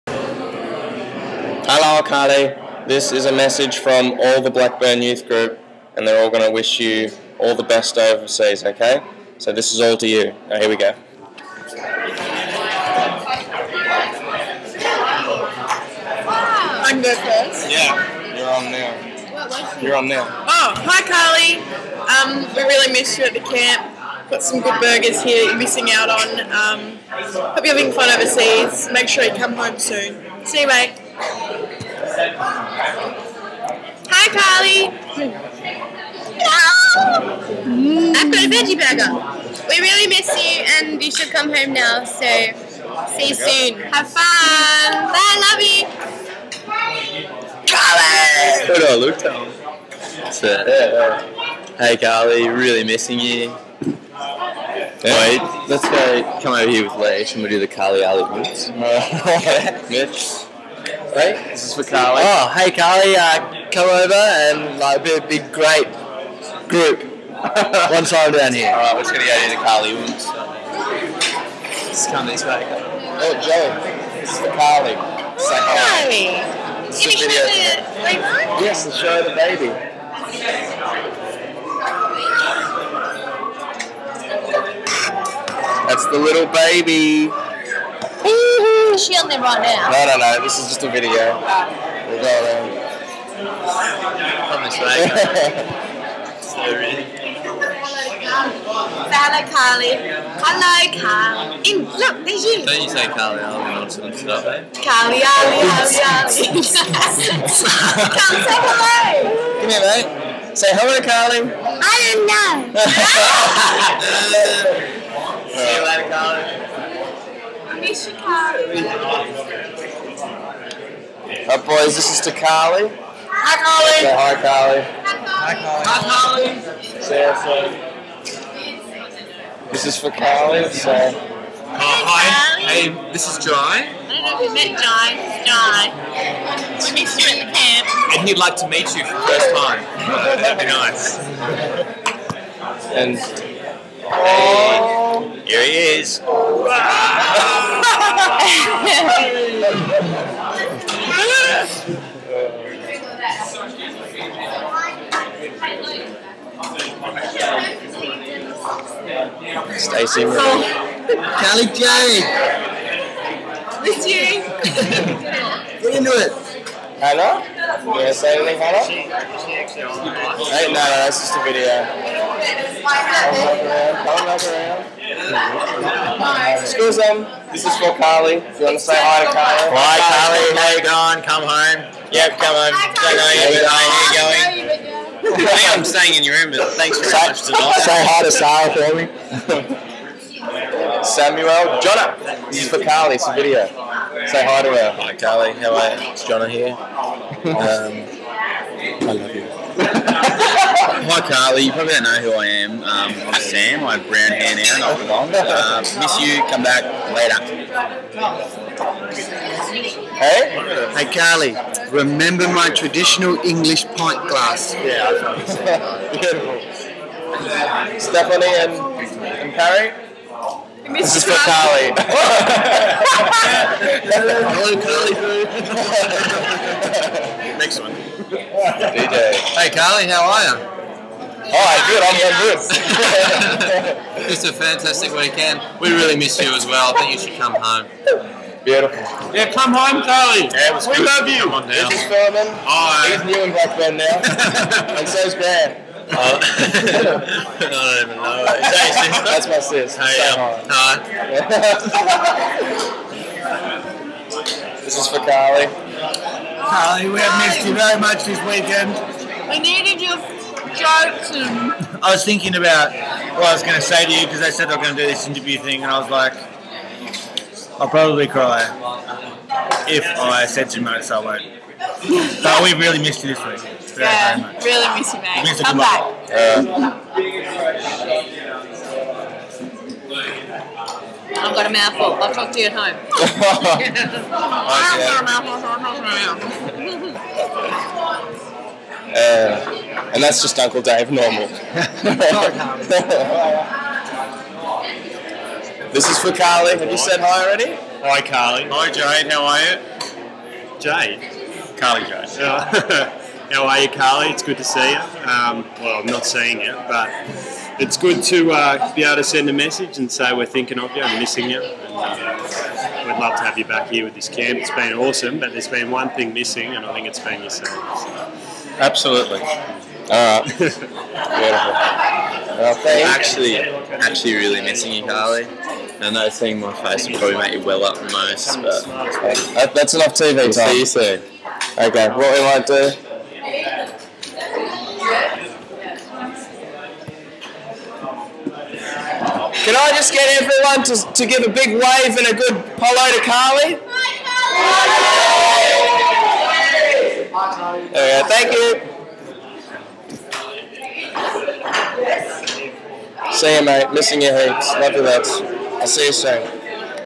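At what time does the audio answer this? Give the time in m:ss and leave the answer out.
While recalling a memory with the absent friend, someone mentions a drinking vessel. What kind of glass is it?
3:32.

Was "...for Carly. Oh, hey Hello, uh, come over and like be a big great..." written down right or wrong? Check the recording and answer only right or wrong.
wrong.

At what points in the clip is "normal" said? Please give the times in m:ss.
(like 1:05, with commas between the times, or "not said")
4:51.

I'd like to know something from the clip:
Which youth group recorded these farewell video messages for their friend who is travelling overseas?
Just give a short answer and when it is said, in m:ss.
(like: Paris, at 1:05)
Blackburn Youth Group, at 0:04.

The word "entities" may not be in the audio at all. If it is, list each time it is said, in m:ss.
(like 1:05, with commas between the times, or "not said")
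not said.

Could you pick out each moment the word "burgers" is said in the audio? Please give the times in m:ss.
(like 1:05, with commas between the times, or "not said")
0:24, 0:38.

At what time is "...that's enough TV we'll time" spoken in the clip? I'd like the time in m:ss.
5:29.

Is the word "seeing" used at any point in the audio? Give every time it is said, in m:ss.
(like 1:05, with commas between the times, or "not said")
5:06, 5:26.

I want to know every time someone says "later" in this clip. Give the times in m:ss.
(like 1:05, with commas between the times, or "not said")
1:55, 3:27.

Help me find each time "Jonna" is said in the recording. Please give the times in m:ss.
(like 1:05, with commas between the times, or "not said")
3:11, 3:16.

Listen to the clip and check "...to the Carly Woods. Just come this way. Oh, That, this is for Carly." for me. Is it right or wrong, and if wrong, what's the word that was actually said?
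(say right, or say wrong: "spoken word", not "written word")
wrong: "Joe", not "That".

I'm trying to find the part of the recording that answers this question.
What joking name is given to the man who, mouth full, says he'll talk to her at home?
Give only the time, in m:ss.
4:50.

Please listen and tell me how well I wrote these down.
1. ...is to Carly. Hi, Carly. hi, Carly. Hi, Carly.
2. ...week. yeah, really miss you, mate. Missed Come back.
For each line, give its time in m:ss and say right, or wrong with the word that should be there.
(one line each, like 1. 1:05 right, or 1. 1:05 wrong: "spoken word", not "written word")
1. 2:02 right
2. 4:33 right.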